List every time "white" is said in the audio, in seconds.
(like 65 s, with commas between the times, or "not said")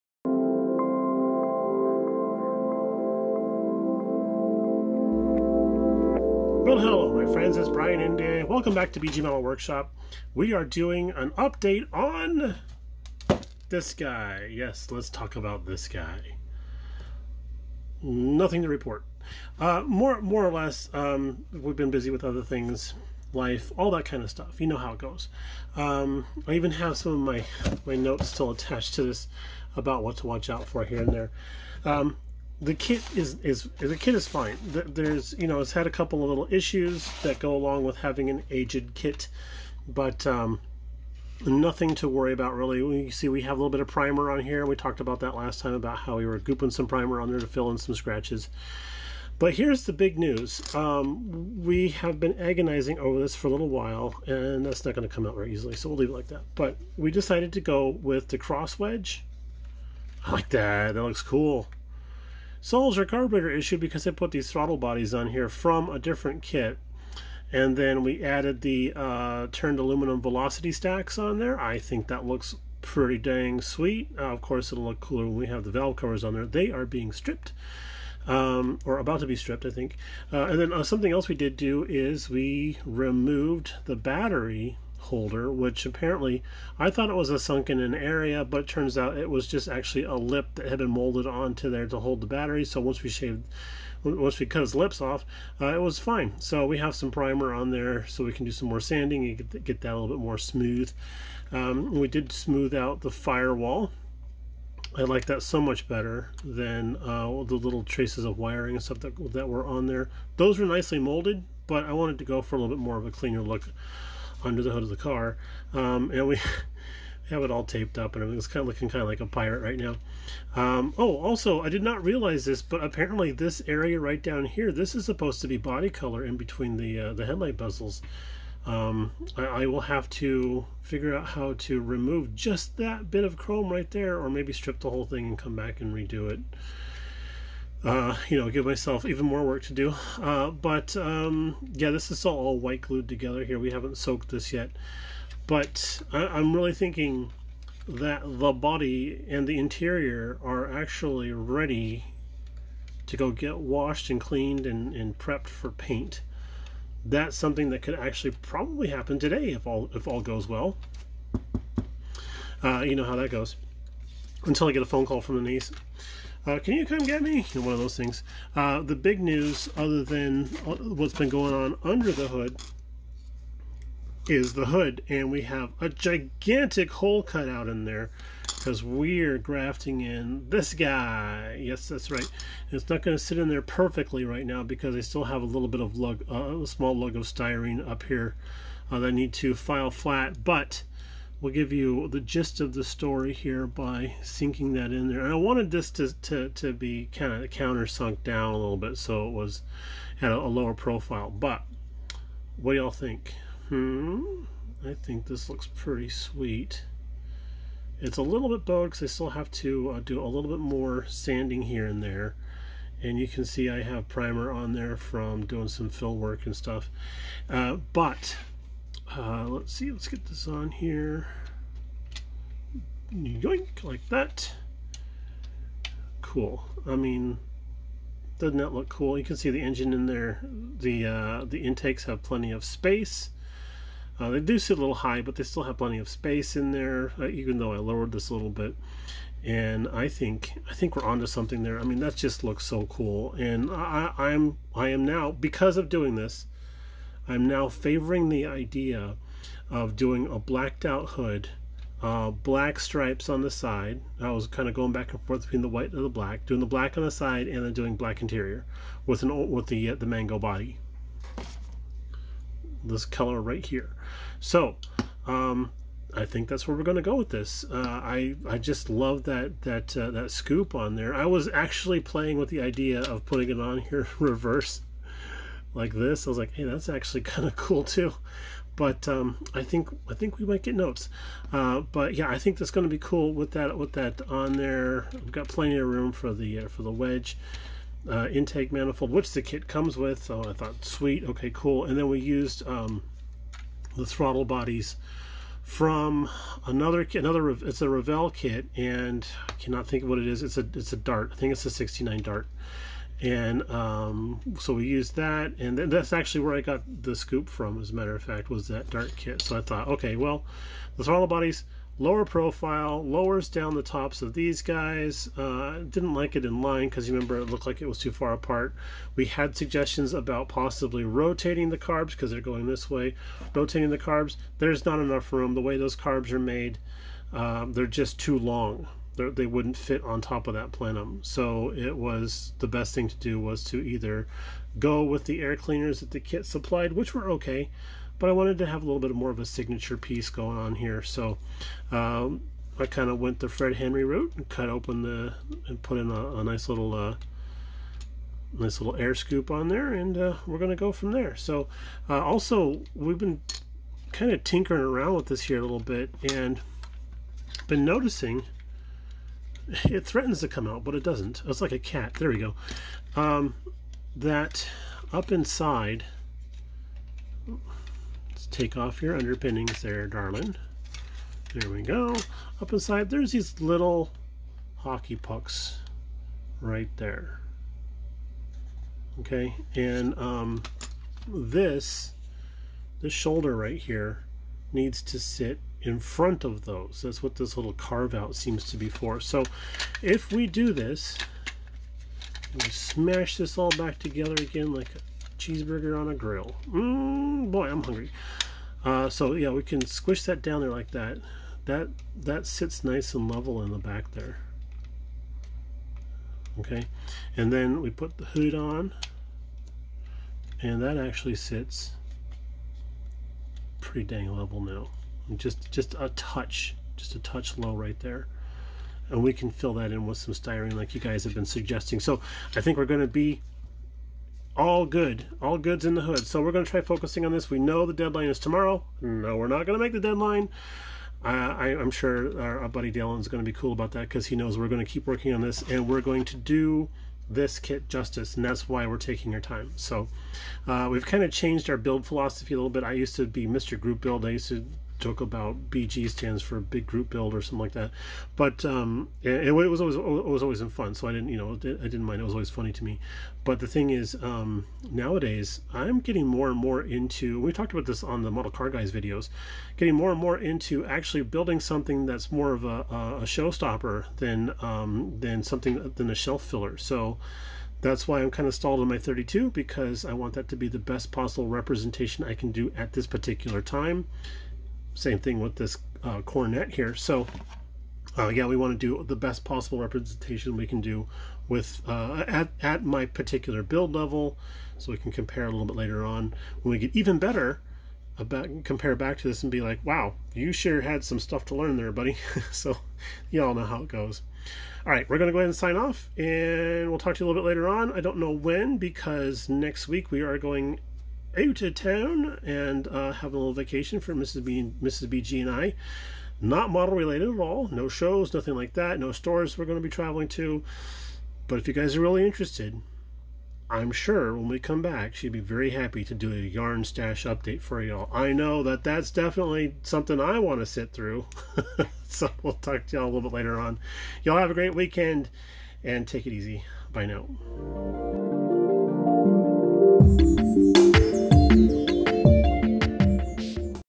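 142 s, 255 s.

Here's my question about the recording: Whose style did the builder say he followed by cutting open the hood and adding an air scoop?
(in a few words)
Fred Henry.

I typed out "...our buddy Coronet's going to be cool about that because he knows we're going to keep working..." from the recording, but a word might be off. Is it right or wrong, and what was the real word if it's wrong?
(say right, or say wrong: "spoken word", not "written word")
wrong: "Dylan", not "Coronet".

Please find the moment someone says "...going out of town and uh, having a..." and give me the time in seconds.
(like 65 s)
500 s.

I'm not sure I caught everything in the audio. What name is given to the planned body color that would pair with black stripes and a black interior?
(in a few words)
Mango.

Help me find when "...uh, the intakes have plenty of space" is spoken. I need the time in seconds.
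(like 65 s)
231 s.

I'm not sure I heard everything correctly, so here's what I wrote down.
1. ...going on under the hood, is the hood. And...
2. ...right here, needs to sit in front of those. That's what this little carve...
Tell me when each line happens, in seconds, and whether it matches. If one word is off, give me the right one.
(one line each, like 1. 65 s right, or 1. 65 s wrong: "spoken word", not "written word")
1. 171 s right
2. 383 s right.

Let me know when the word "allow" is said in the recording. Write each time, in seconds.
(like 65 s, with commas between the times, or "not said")
not said.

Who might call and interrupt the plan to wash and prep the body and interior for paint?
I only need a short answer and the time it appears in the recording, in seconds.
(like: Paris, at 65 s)
The niece, at 165 s.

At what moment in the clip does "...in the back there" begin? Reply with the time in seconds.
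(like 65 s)
403 s.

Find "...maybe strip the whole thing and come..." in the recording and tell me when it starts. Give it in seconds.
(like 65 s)
134 s.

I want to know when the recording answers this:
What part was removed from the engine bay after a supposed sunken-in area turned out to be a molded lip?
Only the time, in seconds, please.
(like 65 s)
83 s.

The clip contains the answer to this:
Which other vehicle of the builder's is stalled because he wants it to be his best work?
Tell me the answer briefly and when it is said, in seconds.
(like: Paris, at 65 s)
His 32, at 468 s.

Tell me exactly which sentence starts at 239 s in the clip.
And I think I think we're onto something there.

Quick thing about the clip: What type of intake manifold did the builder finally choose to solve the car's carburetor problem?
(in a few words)
Cross wedge.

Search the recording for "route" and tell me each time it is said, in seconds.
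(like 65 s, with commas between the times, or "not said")
344 s.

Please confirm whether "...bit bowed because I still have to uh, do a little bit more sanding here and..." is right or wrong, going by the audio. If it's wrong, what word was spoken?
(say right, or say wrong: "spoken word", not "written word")
right.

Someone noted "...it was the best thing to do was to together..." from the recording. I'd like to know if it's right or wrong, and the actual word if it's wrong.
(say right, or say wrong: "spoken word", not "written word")
wrong: "either", not "together".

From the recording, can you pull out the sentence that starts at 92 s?
So once we shaved, once we cut his lips off, uh, it was fine.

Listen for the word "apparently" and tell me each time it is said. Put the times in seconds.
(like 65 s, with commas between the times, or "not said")
85 s, 122 s.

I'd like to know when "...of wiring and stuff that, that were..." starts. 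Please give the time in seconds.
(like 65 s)
108 s.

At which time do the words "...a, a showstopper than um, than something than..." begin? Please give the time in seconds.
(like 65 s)
462 s.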